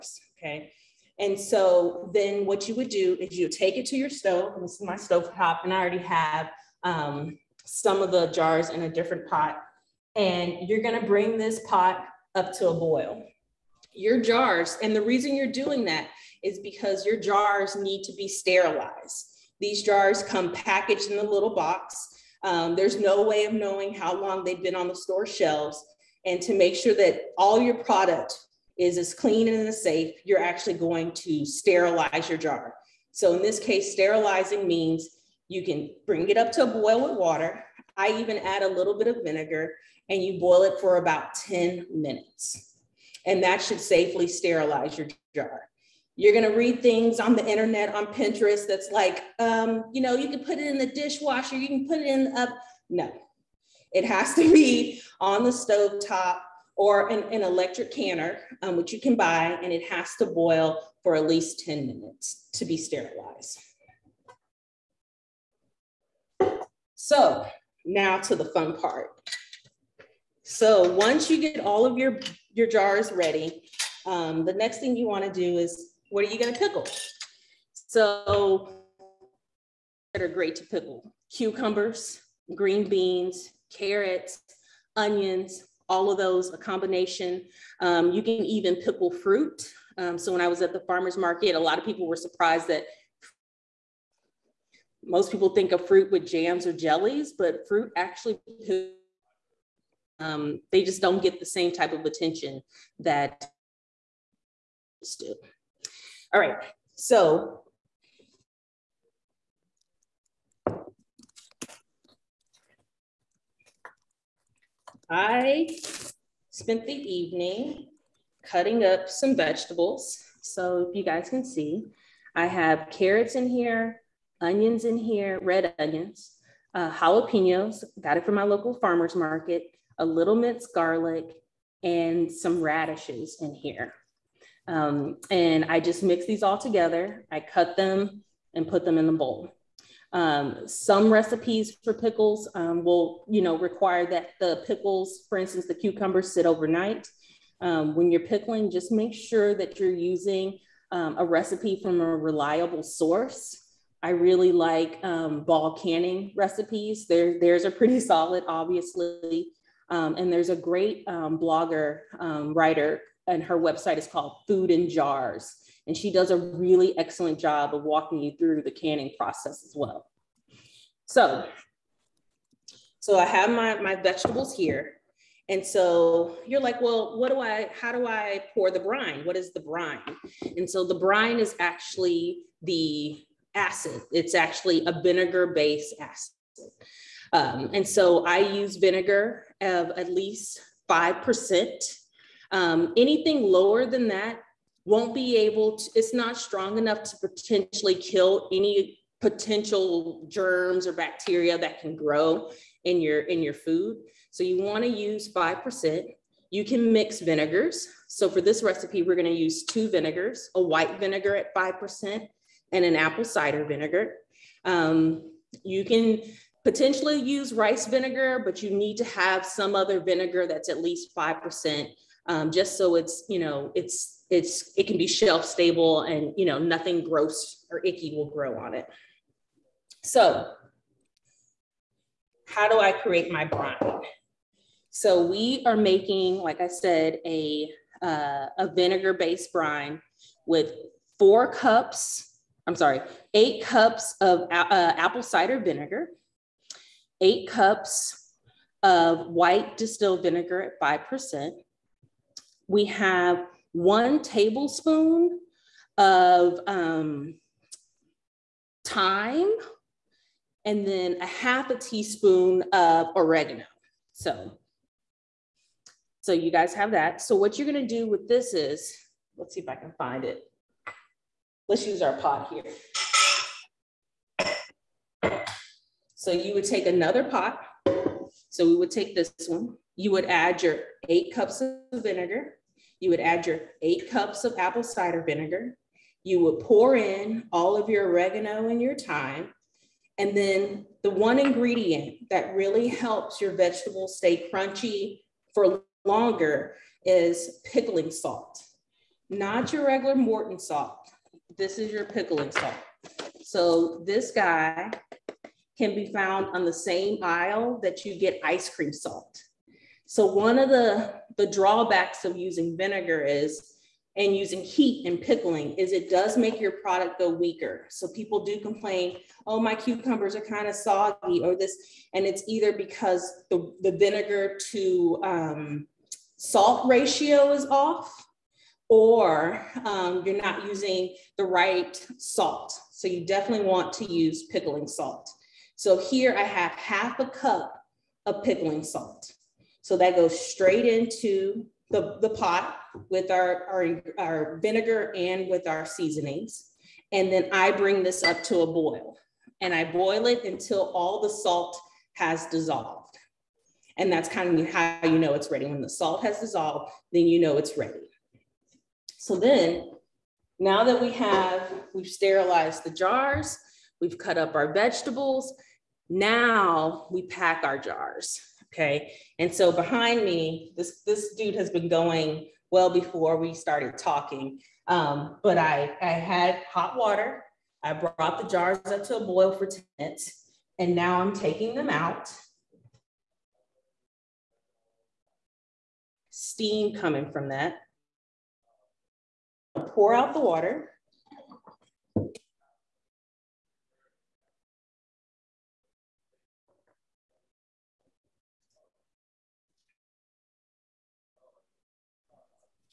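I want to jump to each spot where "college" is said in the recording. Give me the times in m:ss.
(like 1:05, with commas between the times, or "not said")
not said.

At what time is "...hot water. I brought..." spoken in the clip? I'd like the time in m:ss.
6:16.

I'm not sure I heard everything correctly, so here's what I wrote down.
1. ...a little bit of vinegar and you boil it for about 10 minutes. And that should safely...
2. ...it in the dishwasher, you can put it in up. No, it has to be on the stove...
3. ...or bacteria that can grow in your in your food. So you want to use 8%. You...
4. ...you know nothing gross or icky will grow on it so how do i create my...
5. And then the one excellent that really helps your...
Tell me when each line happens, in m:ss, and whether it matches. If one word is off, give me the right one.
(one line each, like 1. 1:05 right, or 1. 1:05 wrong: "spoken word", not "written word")
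1. 0:38 right
2. 0:50 right
3. 3:20 wrong: "5", not "8"
4. 3:46 right
5. 4:50 wrong: "ingredient", not "excellent".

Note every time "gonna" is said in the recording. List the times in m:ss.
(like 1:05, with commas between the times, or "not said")
0:10, 4:27.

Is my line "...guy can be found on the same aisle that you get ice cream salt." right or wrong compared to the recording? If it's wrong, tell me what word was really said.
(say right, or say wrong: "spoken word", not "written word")
right.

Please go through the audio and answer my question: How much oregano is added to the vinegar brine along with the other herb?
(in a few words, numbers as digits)
half a teaspoon.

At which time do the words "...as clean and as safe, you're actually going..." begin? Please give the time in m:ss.
0:28.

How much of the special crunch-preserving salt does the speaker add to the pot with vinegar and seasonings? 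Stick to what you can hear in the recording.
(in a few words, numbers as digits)
half a cup.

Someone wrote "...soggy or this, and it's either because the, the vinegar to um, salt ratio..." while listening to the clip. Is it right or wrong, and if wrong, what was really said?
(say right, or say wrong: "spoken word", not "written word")
right.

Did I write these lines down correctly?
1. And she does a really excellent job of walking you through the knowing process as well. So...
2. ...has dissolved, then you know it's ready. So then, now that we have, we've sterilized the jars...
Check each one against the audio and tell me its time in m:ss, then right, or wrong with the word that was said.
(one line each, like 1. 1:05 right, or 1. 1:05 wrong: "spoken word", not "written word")
1. 2:45 wrong: "canning", not "knowing"
2. 5:56 right.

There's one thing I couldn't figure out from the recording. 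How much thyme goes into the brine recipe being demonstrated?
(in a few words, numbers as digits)
1 tablespoon.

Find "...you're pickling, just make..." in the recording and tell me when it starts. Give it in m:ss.
2:28.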